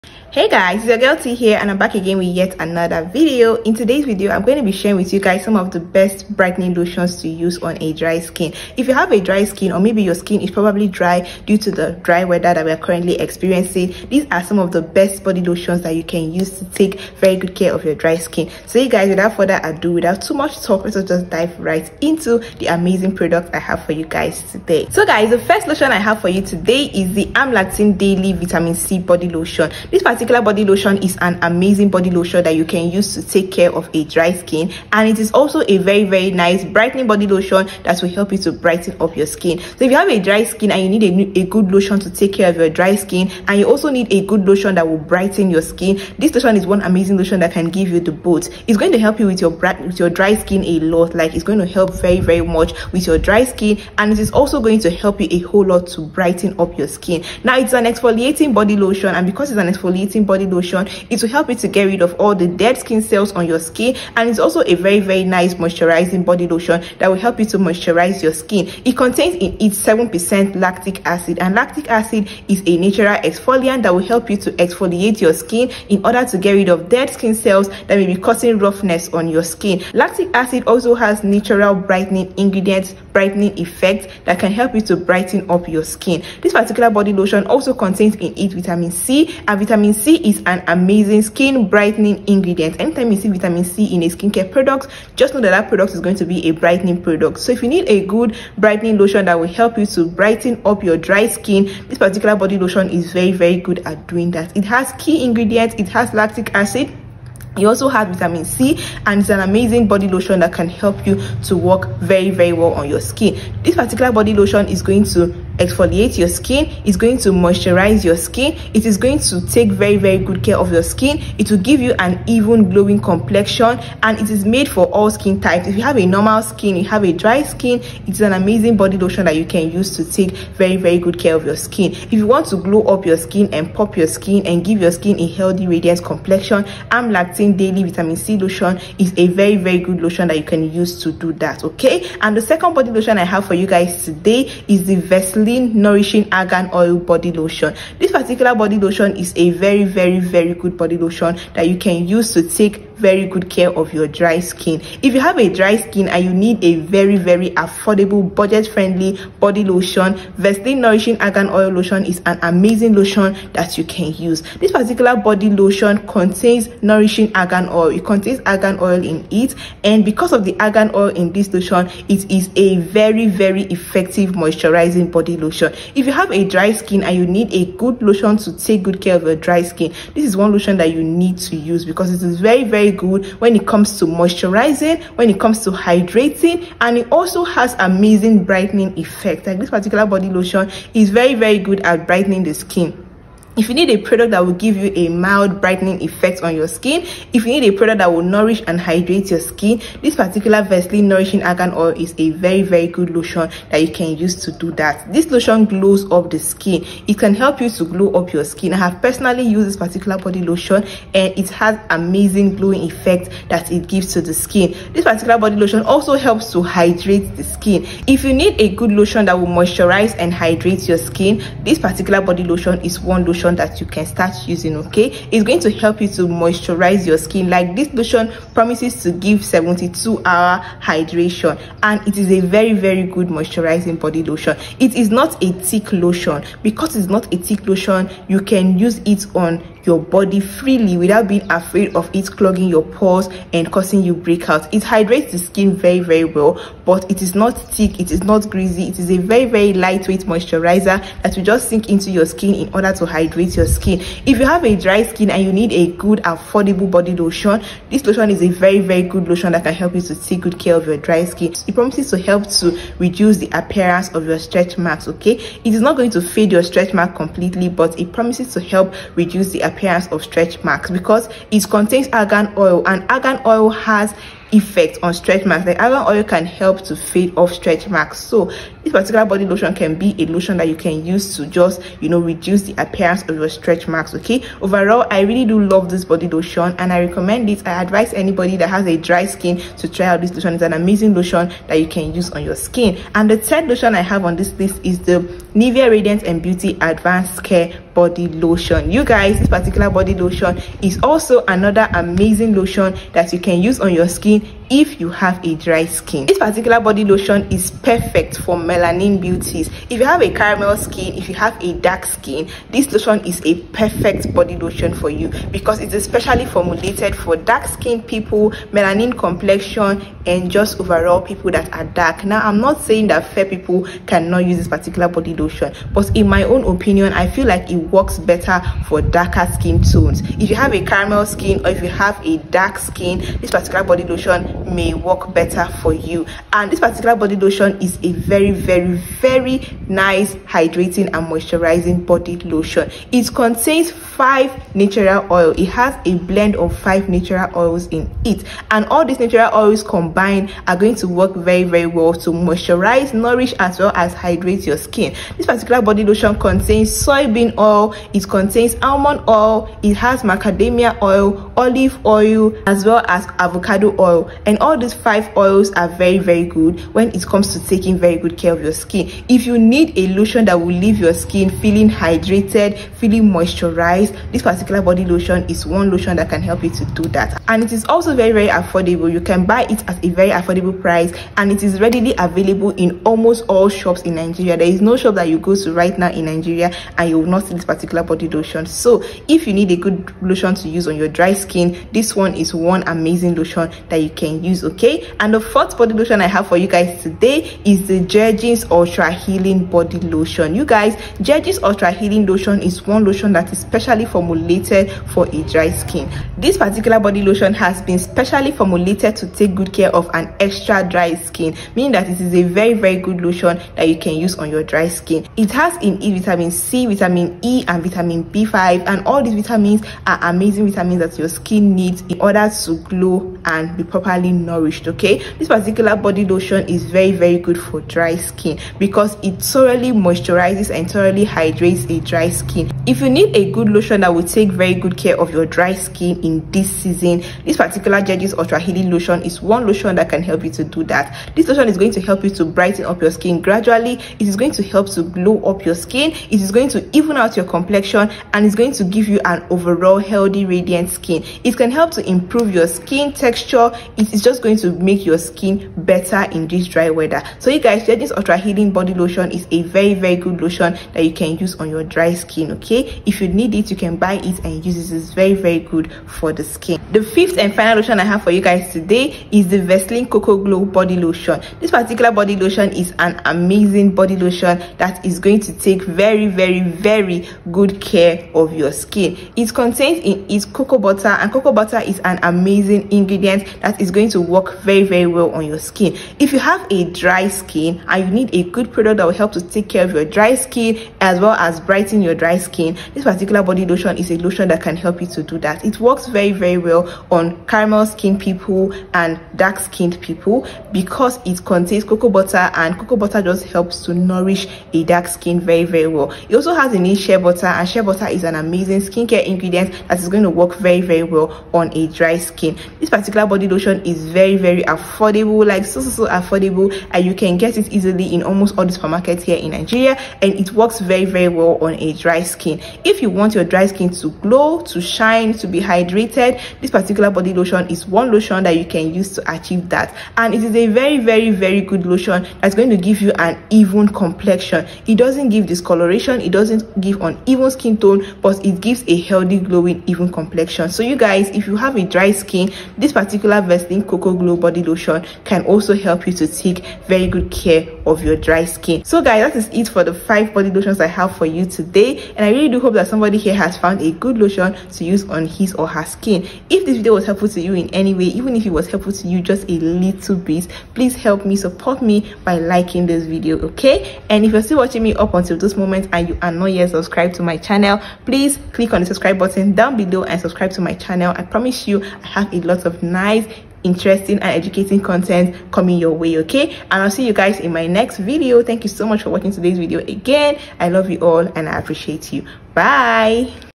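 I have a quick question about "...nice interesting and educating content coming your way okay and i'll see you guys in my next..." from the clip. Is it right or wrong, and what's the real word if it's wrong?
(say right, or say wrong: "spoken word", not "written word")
right.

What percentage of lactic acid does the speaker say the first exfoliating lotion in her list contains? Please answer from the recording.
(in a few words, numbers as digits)
7%.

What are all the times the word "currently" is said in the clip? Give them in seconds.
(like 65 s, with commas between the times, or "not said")
12 s.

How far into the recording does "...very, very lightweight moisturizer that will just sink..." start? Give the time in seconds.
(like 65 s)
249 s.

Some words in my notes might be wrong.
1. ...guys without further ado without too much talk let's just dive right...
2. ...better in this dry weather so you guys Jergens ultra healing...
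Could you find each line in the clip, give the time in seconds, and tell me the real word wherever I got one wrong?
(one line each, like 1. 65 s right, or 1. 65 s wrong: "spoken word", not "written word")
1. 18 s right
2. 455 s right.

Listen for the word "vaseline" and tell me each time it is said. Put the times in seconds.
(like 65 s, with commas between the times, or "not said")
144 s, 160 s, 200 s, 469 s, 543 s.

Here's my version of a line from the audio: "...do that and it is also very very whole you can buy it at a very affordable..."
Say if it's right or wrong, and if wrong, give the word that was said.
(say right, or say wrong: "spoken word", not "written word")
wrong: "affordable", not "whole".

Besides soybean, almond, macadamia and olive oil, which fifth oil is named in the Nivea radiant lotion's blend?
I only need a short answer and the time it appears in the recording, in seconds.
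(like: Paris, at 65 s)
Avocado oil, at 363 s.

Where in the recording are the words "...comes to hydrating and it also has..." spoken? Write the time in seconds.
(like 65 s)
185 s.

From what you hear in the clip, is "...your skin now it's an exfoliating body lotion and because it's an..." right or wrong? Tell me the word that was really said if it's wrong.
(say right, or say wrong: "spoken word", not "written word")
right.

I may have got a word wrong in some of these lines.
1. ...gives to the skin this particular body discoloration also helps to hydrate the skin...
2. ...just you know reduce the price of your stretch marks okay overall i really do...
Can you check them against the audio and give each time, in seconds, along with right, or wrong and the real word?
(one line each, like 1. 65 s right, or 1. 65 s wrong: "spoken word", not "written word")
1. 213 s wrong: "lotion", not "discoloration"
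2. 281 s wrong: "appearance", not "price".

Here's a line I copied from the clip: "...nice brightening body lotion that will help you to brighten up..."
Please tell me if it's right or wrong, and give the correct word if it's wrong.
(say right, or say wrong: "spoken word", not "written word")
right.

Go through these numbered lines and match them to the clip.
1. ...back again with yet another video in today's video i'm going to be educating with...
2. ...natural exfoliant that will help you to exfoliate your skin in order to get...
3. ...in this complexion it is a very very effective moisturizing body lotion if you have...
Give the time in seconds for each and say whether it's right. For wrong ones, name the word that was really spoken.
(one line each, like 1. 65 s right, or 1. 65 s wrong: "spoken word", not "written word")
1. 1 s wrong: "sharing", not "educating"
2. 72 s right
3. 171 s wrong: "lotion", not "complexion".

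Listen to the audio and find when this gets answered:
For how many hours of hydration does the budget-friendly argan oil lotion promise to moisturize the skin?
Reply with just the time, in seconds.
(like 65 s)
229 s.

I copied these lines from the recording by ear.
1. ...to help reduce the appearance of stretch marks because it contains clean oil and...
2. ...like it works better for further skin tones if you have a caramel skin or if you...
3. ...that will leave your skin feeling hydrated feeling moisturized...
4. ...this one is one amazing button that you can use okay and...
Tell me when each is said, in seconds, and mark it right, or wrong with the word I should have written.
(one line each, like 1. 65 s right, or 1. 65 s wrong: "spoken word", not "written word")
1. 268 s wrong: "argan", not "clean"
2. 327 s wrong: "darker", not "further"
3. 370 s right
4. 391 s wrong: "lotion", not "button".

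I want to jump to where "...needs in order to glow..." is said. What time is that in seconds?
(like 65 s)
421 s.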